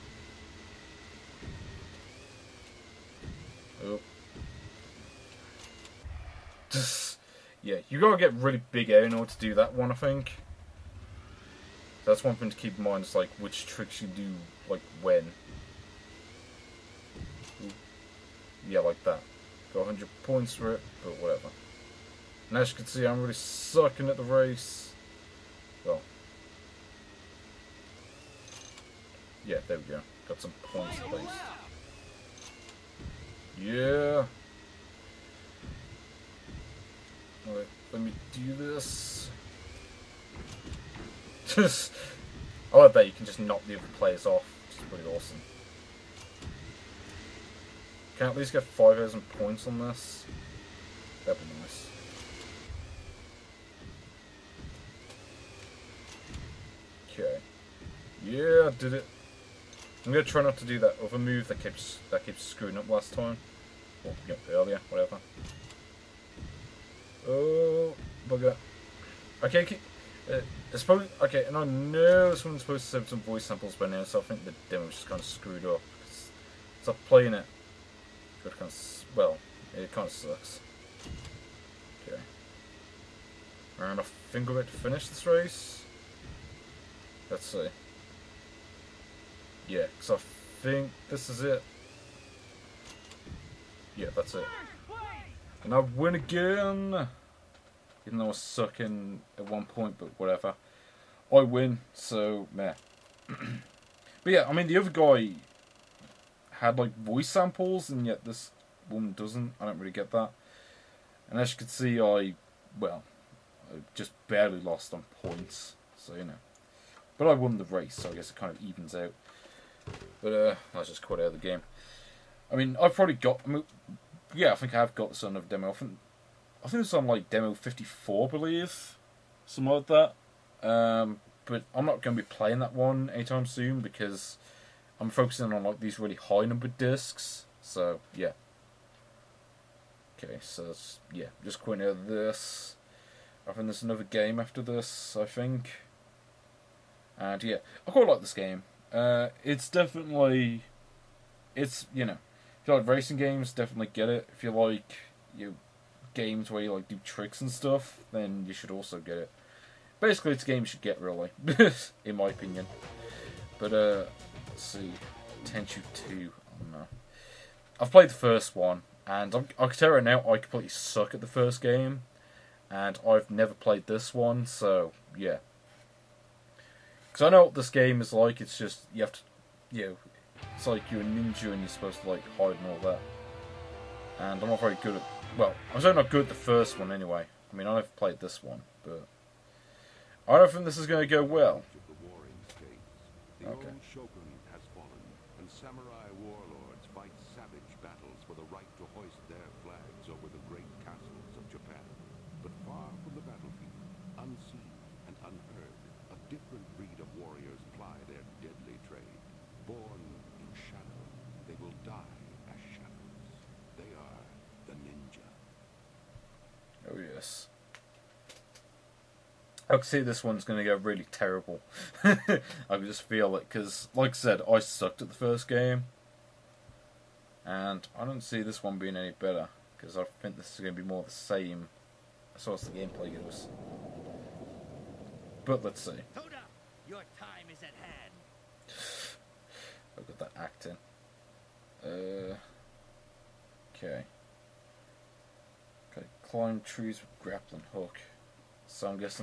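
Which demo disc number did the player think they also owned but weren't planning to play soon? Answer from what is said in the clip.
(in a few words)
54.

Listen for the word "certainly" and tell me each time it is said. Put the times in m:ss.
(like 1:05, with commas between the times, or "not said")
3:05.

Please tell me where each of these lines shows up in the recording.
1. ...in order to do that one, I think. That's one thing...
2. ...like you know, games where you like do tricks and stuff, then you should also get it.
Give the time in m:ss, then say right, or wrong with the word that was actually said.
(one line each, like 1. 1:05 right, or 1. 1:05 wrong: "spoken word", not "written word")
1. 0:09 right
2. 2:34 right.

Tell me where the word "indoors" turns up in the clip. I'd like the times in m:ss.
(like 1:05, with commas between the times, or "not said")
not said.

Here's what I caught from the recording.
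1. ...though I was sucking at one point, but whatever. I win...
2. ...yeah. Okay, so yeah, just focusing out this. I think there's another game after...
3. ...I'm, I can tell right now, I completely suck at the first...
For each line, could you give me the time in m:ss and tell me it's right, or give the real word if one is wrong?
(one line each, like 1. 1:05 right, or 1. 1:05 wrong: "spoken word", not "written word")
1. 1:38 right
2. 2:18 wrong: "quitting", not "focusing"
3. 2:49 right.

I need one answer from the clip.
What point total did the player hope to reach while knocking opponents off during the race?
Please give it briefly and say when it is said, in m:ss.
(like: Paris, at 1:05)
5,000, at 0:48.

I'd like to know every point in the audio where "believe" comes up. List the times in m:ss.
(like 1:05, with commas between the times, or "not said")
2:08.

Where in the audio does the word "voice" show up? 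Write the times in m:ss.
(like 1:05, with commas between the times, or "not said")
1:13, 1:46.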